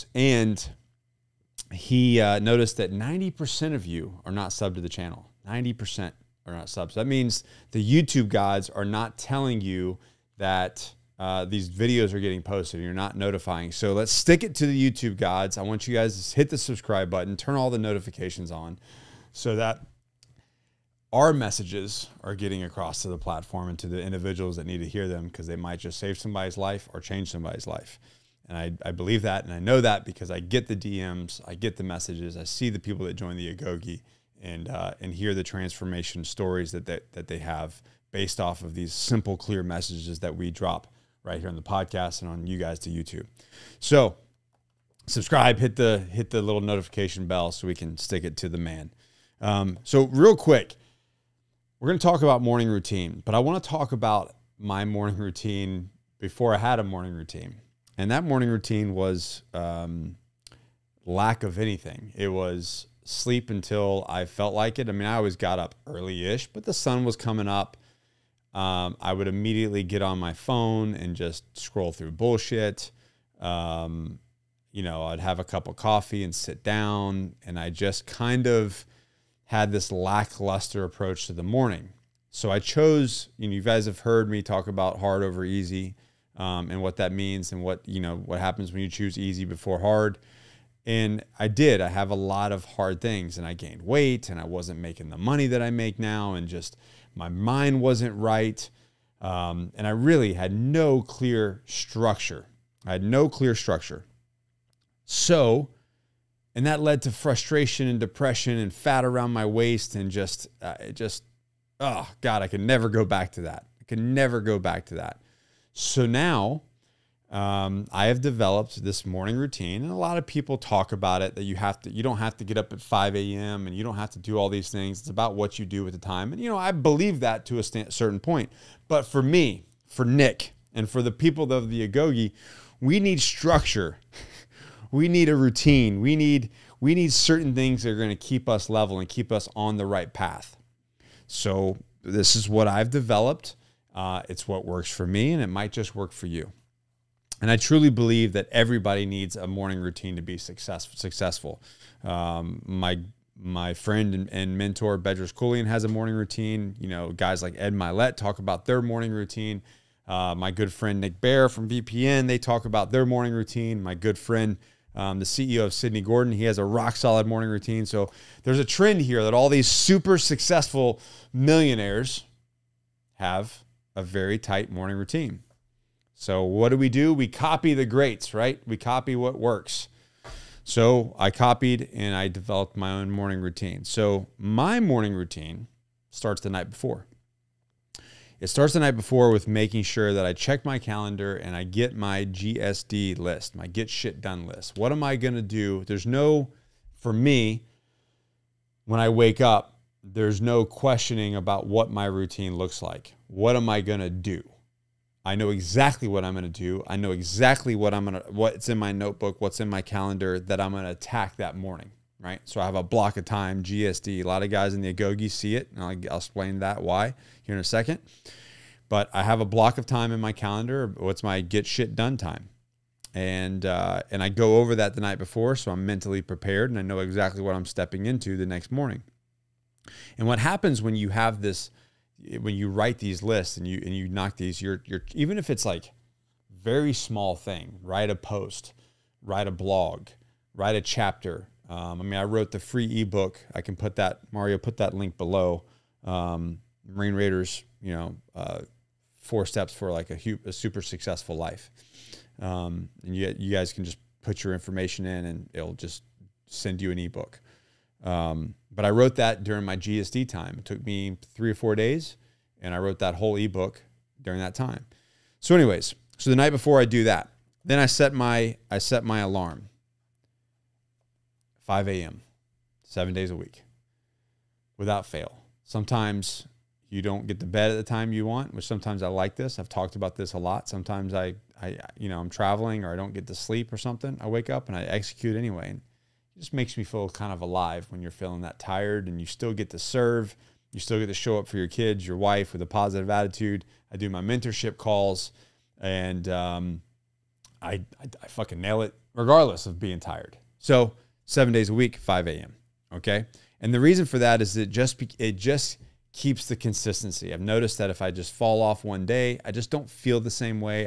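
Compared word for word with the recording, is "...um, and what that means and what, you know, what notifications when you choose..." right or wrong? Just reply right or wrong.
wrong.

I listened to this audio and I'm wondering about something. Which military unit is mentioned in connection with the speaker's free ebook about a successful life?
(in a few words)
Marine Raiders.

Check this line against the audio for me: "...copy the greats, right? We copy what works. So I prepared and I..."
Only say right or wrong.
wrong.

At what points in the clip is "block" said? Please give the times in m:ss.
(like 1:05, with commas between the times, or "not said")
3:32, 3:39.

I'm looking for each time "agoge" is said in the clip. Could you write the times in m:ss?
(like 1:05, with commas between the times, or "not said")
0:33, 2:11, 3:34.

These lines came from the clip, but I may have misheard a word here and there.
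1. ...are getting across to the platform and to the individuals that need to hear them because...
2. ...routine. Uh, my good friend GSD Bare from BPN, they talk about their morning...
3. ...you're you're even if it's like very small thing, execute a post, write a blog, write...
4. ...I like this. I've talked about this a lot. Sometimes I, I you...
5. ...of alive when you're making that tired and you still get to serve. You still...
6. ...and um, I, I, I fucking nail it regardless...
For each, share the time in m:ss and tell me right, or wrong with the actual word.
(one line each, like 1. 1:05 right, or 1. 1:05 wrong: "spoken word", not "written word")
1. 0:22 right
2. 2:39 wrong: "Nick", not "GSD"
3. 3:54 wrong: "write", not "execute"
4. 4:39 right
5. 4:47 wrong: "feeling", not "making"
6. 4:55 right.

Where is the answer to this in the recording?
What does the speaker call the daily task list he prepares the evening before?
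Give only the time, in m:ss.
3:13.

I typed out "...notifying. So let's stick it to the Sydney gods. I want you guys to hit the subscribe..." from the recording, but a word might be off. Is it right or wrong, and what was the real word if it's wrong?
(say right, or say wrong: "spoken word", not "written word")
wrong: "YouTube", not "Sydney".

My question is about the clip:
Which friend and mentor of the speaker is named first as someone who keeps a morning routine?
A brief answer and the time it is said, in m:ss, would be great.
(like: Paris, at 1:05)
Bedros Keuilian, at 2:34.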